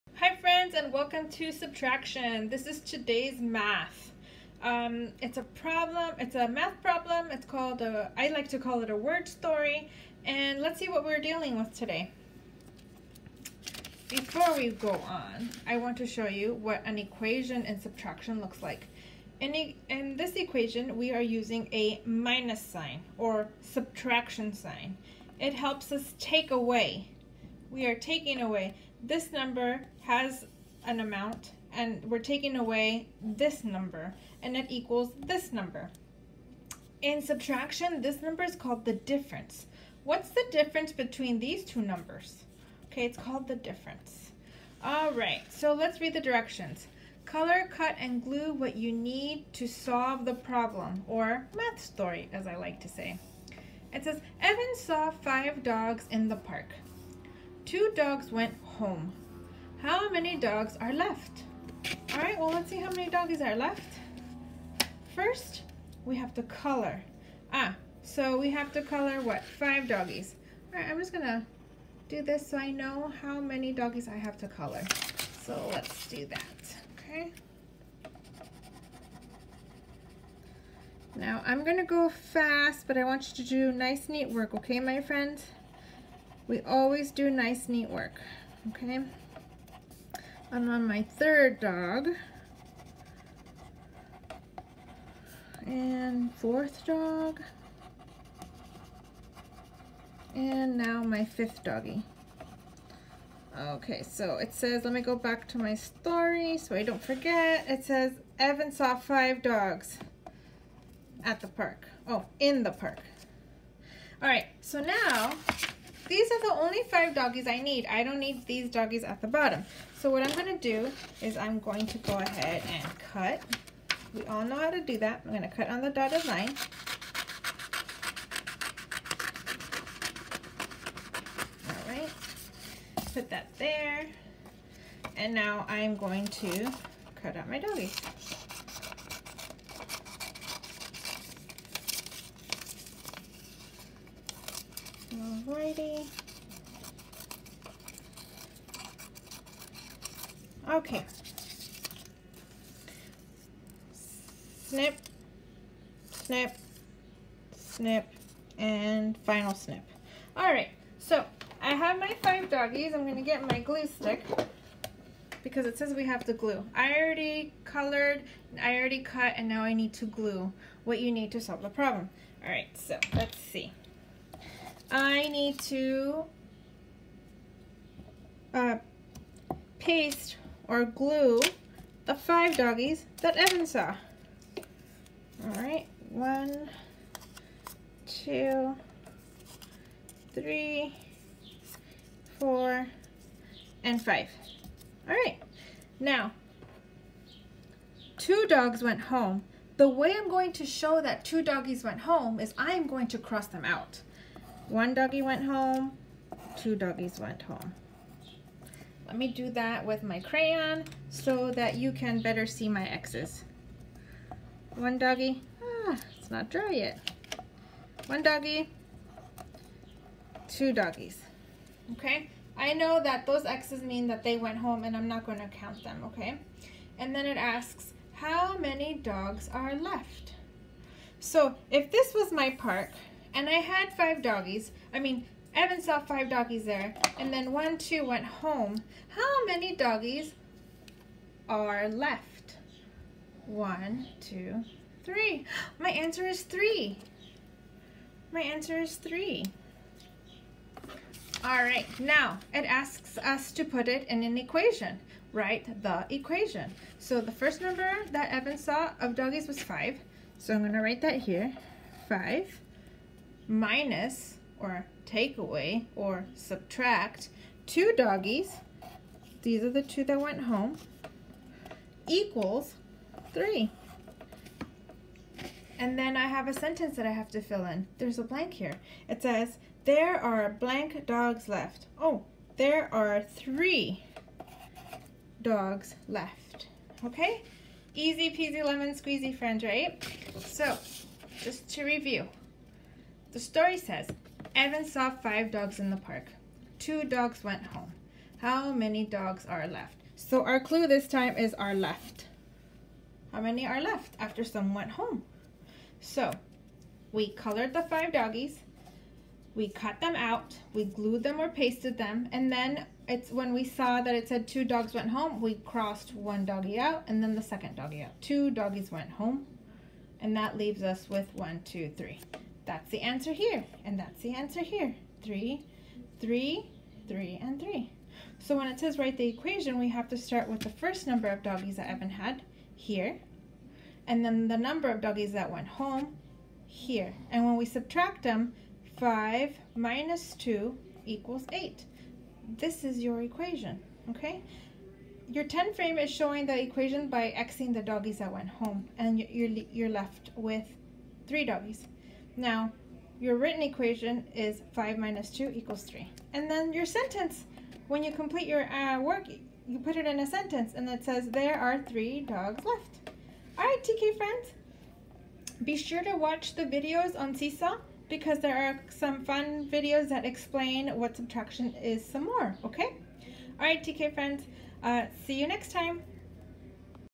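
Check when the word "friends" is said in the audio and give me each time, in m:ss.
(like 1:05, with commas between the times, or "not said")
1:25, 4:49, 6:04, 6:14.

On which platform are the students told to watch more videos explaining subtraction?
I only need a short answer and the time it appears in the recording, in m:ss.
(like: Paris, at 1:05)
Seesaw, at 6:07.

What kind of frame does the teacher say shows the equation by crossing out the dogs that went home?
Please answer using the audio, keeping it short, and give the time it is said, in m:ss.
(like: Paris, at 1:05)
10 frame, at 5:45.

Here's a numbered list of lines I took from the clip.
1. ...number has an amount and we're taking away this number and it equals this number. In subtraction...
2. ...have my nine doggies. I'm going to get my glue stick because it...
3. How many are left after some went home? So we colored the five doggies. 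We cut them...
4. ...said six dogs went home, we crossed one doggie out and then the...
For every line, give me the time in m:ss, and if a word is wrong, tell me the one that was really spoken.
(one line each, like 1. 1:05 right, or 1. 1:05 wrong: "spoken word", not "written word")
1. 0:29 right
2. 2:41 wrong: "five", not "nine"
3. 5:03 right
4. 5:14 wrong: "two", not "six".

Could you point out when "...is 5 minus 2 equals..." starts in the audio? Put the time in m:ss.
5:54.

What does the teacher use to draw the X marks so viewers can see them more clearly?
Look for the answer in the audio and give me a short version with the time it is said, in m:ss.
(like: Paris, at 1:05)
crayon, at 3:30.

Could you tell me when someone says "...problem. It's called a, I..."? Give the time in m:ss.
0:06.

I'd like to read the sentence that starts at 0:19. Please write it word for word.
In, e in this equation, we are using a minus sign or subtraction sign.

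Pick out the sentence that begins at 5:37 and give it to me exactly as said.
And when we subtract them, 5 minus 2 equals 8.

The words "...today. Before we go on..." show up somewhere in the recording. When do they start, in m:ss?
0:11.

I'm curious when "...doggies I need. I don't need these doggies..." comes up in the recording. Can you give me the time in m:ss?
1:57.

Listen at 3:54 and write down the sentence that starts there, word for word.
I mean, Evan saw five doggies there.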